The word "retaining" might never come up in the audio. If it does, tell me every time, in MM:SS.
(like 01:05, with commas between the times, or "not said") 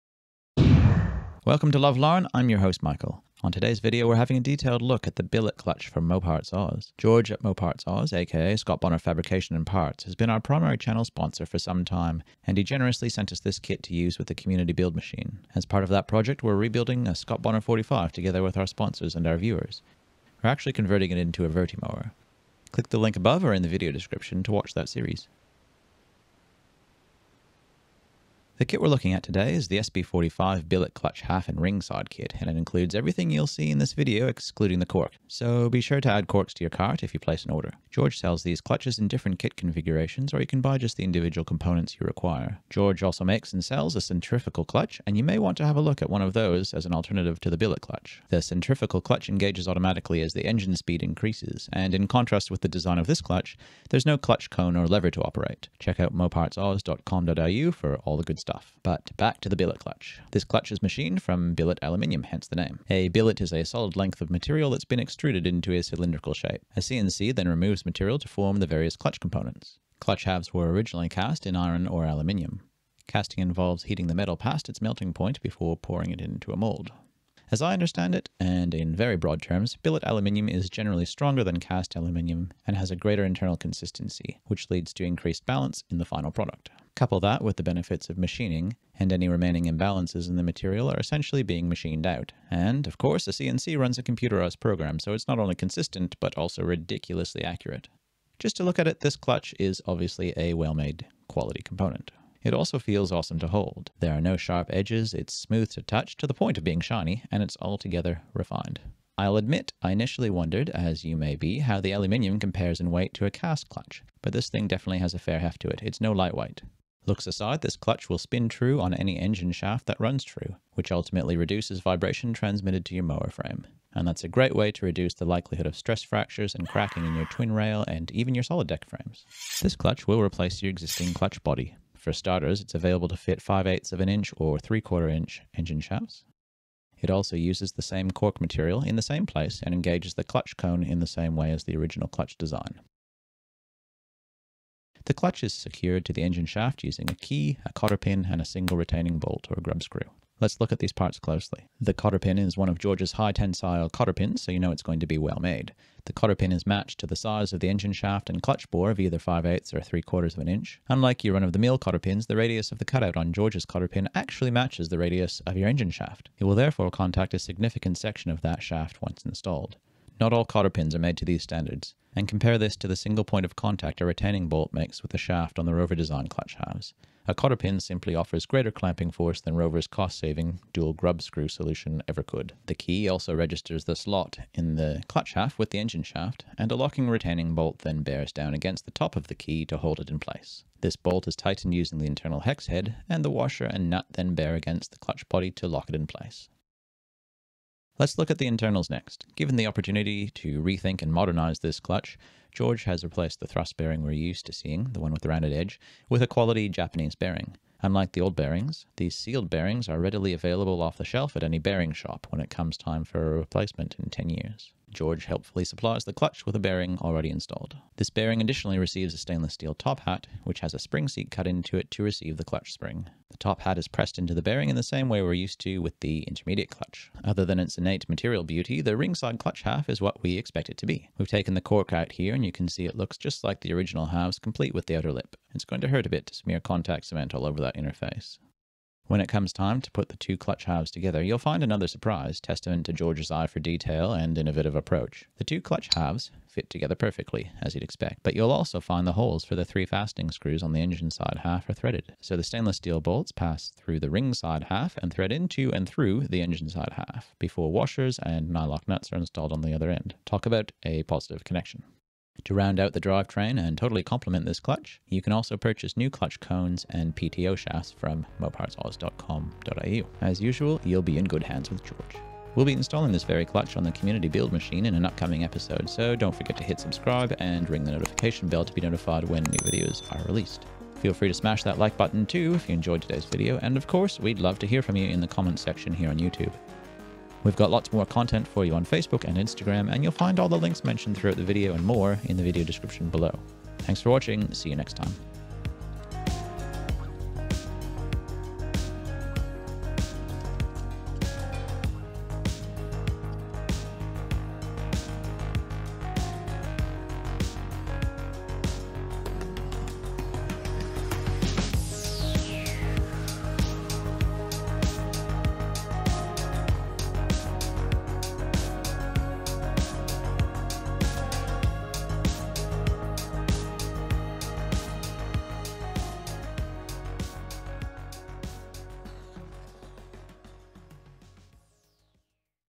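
02:28, 02:54, 03:07.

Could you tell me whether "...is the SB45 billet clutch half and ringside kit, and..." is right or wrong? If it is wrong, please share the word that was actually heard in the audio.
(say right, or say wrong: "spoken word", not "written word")
right.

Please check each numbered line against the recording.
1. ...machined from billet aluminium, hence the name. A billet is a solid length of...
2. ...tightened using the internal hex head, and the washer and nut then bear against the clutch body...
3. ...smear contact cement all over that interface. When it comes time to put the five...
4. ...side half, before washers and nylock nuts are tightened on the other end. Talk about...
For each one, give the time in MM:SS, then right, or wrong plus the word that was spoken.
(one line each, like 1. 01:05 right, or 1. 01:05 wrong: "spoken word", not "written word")
1. 01:00 right
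2. 03:11 right
3. 03:56 wrong: "two", not "five"
4. 04:16 wrong: "installed", not "tightened".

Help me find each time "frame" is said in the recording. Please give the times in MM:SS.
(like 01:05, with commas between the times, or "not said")
02:03, 02:08.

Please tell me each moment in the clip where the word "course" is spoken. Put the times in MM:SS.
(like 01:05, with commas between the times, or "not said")
01:32, 04:43.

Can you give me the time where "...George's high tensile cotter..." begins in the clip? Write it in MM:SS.
02:32.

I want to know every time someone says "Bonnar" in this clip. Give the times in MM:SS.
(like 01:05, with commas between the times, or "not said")
00:08, 00:17.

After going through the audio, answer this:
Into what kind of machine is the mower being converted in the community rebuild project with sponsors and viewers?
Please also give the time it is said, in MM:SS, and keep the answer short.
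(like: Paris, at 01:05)
Vertimower, at 00:21.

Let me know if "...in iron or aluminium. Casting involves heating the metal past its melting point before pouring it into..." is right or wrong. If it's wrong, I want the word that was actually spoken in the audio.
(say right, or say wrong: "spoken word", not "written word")
right.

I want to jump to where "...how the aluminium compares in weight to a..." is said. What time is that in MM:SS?
01:51.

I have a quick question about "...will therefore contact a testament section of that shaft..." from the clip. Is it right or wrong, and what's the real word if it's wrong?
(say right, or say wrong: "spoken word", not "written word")
wrong: "significant", not "testament".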